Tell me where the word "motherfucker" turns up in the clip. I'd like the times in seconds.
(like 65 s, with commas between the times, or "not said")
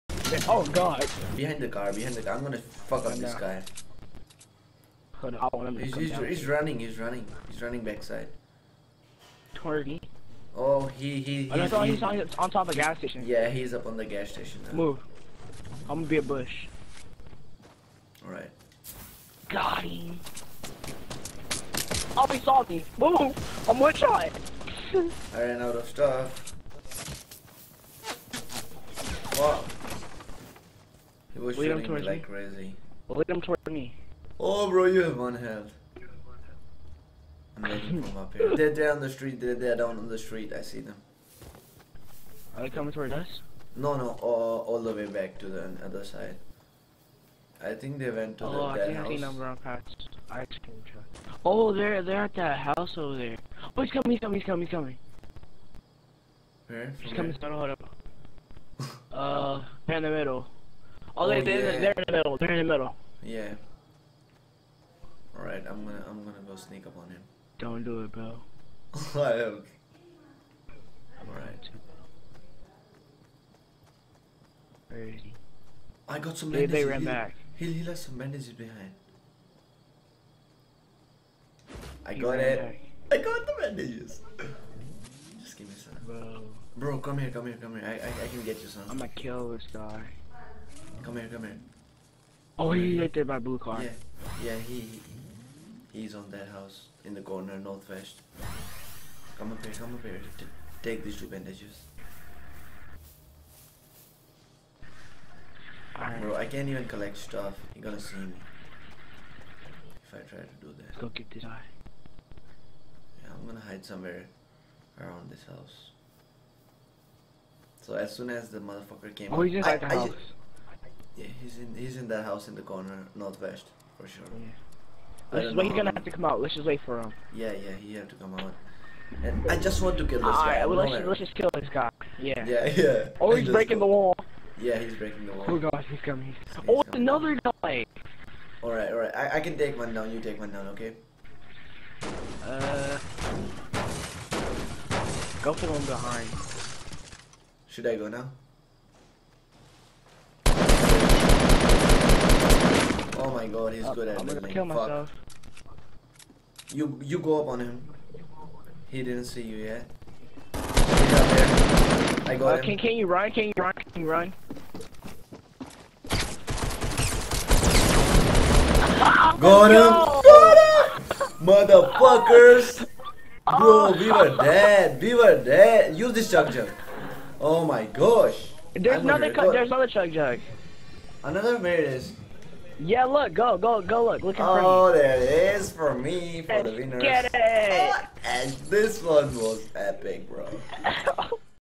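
118 s, 171 s.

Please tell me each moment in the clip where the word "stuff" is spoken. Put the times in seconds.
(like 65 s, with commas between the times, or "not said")
25 s, 107 s.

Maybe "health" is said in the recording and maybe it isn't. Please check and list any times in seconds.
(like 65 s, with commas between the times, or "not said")
35 s.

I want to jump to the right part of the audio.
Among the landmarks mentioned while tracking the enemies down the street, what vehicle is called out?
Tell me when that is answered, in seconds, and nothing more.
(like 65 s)
50 s.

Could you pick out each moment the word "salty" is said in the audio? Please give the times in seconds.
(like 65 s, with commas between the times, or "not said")
22 s.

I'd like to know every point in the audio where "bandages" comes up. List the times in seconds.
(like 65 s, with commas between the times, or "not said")
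78 s, 83 s, 101 s.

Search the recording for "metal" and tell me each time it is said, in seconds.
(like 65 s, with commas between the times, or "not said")
not said.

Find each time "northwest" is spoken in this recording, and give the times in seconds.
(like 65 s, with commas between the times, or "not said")
97 s, 123 s.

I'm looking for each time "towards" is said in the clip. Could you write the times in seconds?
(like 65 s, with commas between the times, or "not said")
33 s, 42 s.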